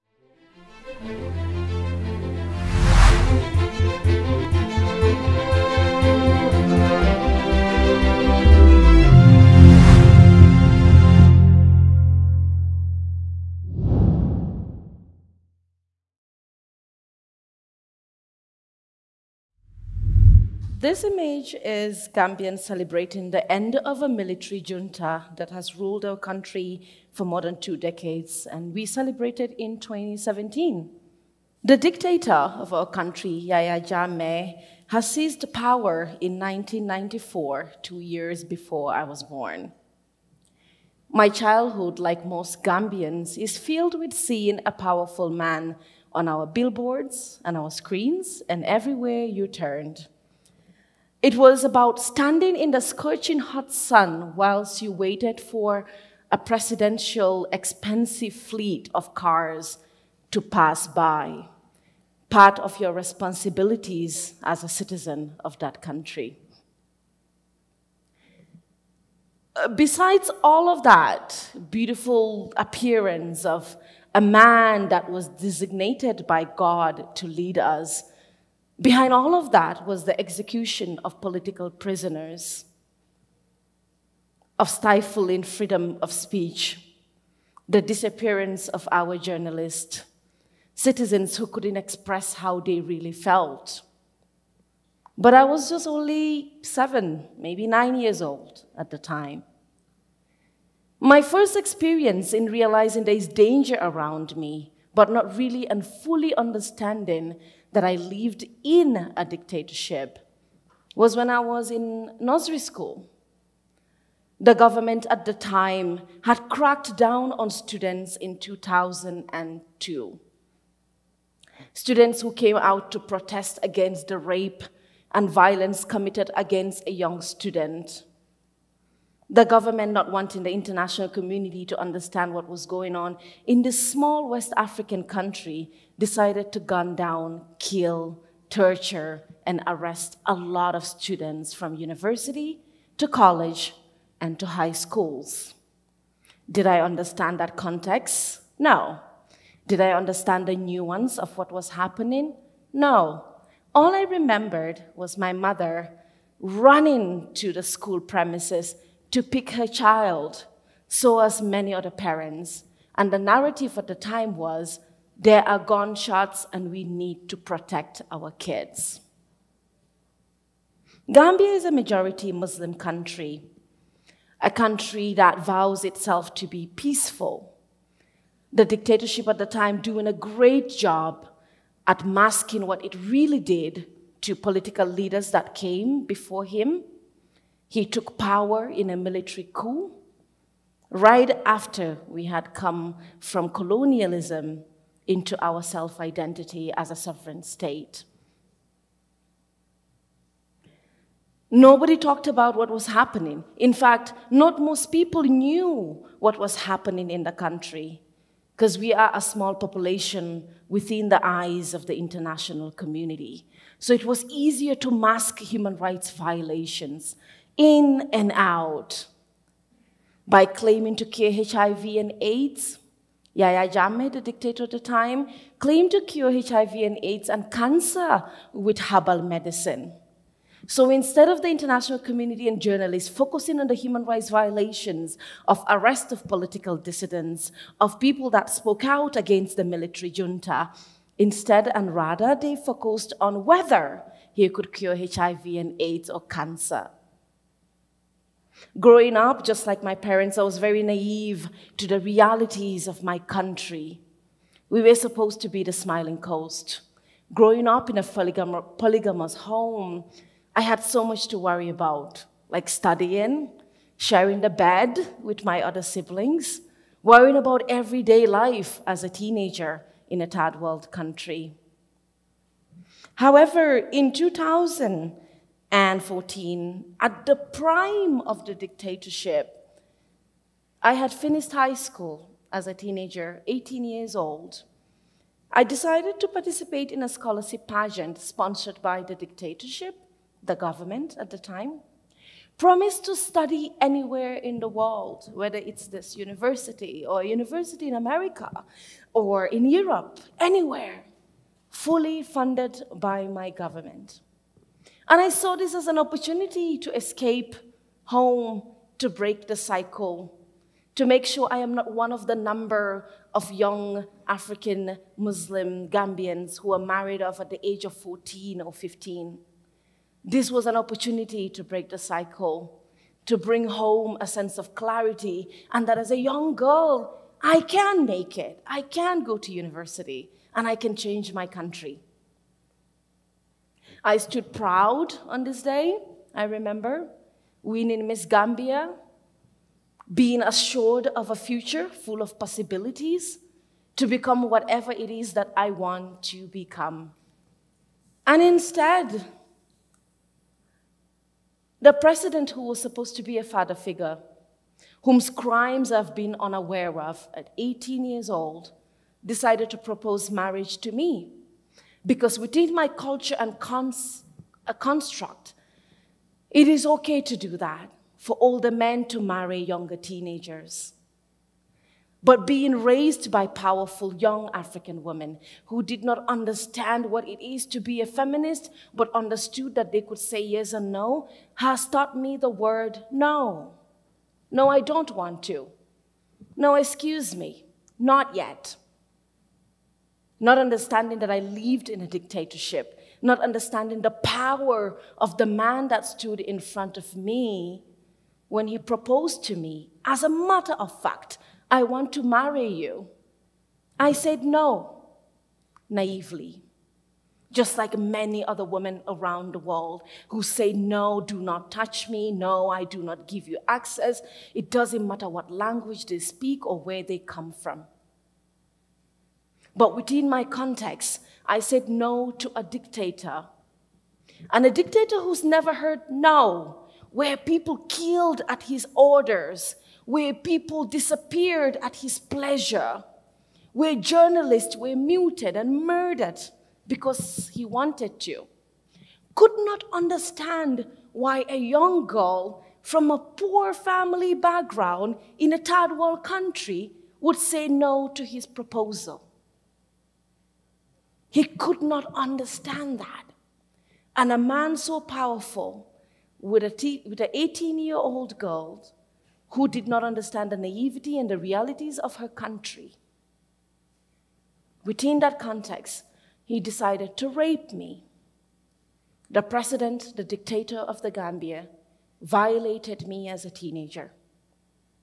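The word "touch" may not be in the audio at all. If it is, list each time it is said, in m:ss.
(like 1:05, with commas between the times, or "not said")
6:51.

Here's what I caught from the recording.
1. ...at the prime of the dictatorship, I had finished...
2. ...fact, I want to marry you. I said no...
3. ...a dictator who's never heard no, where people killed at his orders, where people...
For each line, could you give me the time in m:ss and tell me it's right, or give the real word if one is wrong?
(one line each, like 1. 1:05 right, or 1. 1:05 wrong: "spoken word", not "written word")
1. 4:36 right
2. 6:41 right
3. 7:04 right.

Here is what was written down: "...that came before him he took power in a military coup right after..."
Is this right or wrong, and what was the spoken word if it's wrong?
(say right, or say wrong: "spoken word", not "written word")
right.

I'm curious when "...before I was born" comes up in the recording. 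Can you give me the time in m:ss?
0:38.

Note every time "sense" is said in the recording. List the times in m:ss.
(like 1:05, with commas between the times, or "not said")
5:24.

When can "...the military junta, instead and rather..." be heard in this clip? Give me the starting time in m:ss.
3:59.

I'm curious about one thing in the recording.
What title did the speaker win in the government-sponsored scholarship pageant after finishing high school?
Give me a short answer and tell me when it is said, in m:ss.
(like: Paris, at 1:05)
Miss Gambia, at 5:38.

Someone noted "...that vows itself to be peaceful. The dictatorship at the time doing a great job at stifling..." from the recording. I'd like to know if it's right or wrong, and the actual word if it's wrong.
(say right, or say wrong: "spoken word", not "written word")
wrong: "masking", not "stifling".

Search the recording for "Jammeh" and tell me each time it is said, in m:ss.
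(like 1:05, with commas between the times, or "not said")
0:33, 3:43.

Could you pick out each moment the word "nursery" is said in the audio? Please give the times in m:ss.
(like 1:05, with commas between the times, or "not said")
1:52.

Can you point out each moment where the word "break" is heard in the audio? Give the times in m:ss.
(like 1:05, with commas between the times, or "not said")
5:09, 5:21.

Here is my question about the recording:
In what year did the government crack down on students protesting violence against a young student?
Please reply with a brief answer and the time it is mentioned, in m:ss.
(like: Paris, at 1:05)
2002, at 1:58.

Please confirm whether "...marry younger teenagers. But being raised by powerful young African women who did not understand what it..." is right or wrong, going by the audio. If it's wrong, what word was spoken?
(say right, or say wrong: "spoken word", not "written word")
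right.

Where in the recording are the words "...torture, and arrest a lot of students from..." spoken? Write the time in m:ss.
2:18.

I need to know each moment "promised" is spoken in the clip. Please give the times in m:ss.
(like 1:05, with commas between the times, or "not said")
4:52.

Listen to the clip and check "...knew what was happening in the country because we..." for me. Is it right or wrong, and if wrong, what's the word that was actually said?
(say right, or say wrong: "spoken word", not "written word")
right.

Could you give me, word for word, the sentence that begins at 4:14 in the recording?
We were supposed to be the smiling coast.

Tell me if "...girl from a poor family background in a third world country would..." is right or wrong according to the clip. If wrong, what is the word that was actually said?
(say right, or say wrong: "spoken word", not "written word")
right.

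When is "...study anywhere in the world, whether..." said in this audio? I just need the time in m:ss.
4:53.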